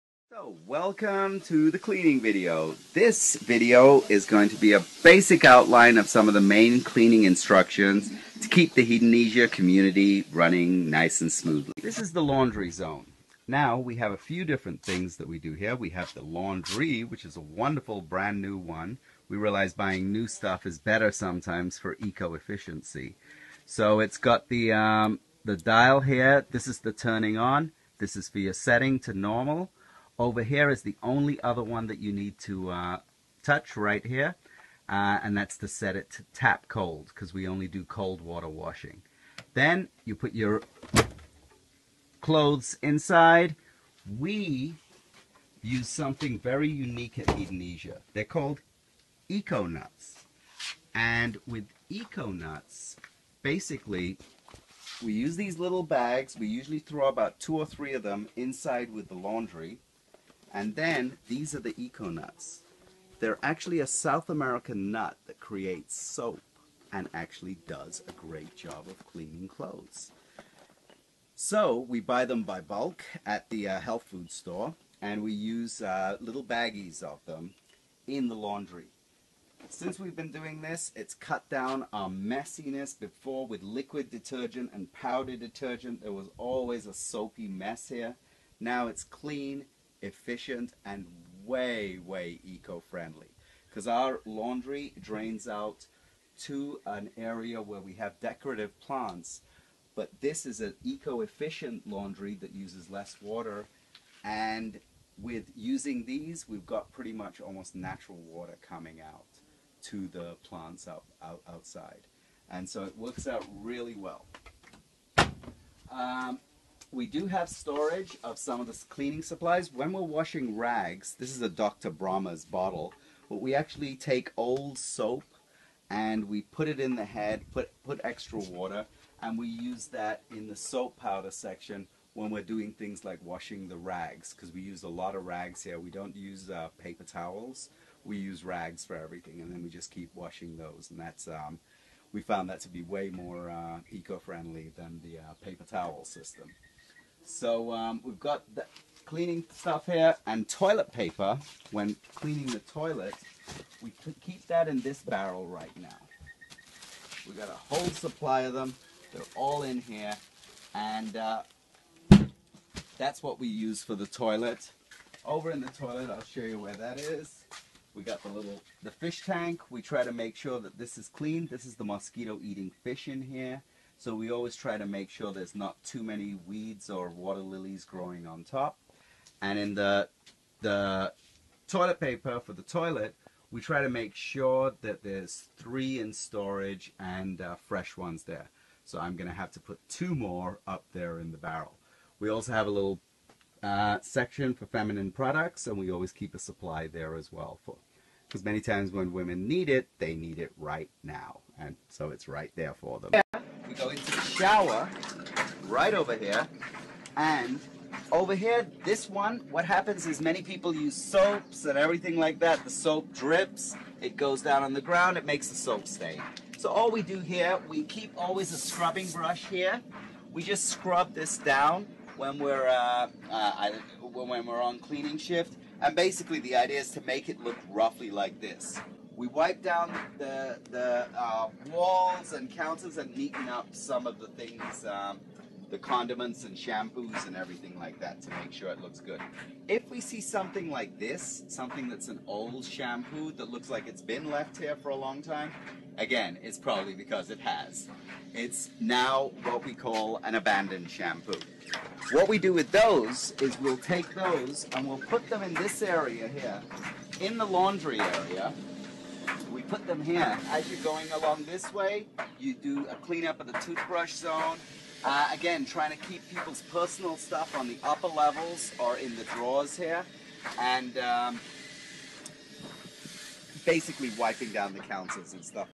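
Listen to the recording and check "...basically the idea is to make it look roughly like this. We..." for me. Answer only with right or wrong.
right.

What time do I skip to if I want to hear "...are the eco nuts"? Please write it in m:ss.
1:01.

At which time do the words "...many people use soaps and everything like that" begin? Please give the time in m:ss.
3:30.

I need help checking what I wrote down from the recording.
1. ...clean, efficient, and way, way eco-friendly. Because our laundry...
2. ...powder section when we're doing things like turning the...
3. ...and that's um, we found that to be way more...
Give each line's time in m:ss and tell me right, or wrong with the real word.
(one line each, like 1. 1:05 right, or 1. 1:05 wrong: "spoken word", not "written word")
1. 1:29 right
2. 2:10 wrong: "washing", not "turning"
3. 2:20 right.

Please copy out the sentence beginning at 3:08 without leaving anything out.
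So I'm going to have to put two more up there in the barrel.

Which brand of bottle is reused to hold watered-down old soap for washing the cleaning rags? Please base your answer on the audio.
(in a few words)
Dr. Bronner's.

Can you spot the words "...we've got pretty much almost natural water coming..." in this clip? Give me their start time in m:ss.
1:46.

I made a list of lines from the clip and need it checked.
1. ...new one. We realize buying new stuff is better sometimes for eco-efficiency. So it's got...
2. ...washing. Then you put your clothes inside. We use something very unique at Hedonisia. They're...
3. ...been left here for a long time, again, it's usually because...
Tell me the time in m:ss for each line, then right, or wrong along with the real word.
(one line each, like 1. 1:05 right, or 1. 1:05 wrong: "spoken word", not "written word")
1. 0:18 right
2. 0:38 right
3. 4:04 wrong: "probably", not "usually".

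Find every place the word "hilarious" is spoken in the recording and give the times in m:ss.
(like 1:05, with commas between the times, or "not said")
not said.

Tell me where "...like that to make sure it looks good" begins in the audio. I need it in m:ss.
3:57.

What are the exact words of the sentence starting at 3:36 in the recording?
So all we do here, we keep always a scrubbing brush here.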